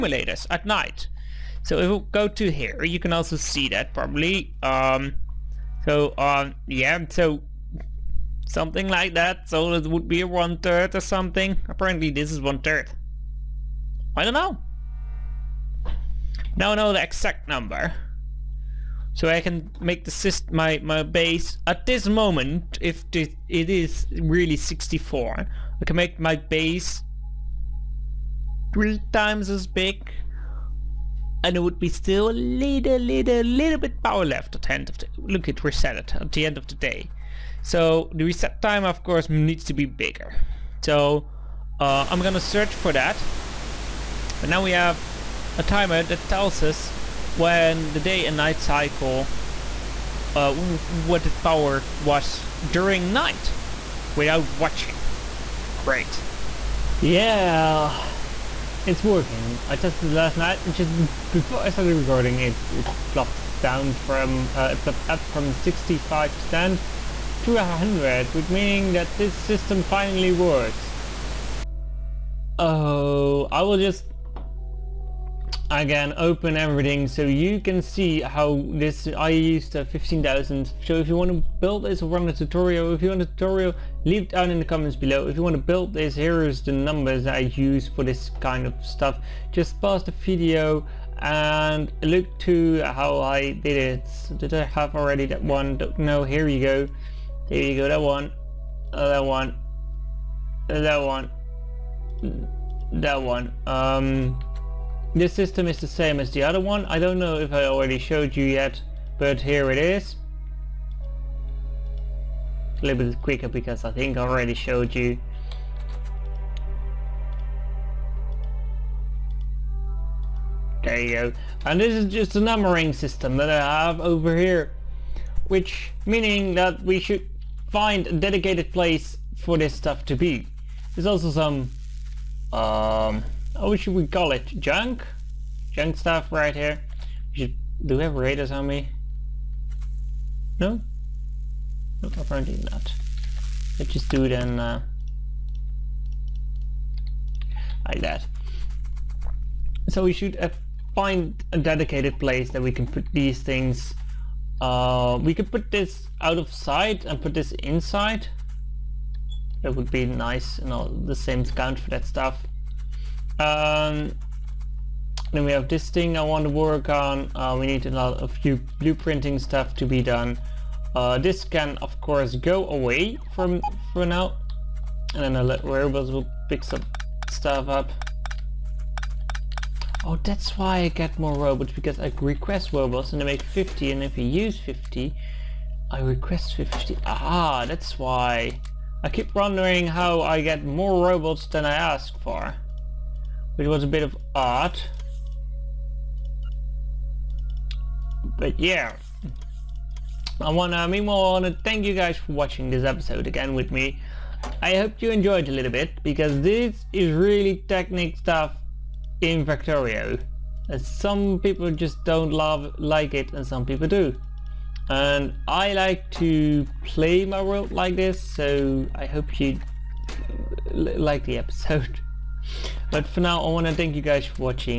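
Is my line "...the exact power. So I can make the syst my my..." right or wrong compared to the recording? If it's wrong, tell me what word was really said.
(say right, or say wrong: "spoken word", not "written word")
wrong: "number", not "power".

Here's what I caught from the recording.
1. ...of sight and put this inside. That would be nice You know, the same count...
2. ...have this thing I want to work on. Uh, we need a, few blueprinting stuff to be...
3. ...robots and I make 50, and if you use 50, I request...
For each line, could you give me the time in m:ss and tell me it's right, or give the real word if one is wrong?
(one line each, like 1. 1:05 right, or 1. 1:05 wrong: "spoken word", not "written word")
1. 2:36 right
2. 2:45 right
3. 3:02 right.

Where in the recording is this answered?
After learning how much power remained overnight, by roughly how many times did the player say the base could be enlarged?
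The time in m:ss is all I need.
0:28.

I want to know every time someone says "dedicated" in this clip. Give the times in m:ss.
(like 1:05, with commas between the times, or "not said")
2:08, 2:31.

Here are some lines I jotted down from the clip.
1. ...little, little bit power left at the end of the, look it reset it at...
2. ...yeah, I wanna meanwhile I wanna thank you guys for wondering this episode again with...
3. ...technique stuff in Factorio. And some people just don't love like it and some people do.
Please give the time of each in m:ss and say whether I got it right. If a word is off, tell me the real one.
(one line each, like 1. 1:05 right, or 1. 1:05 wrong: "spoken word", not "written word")
1. 0:32 right
2. 3:18 wrong: "watching", not "wondering"
3. 3:27 right.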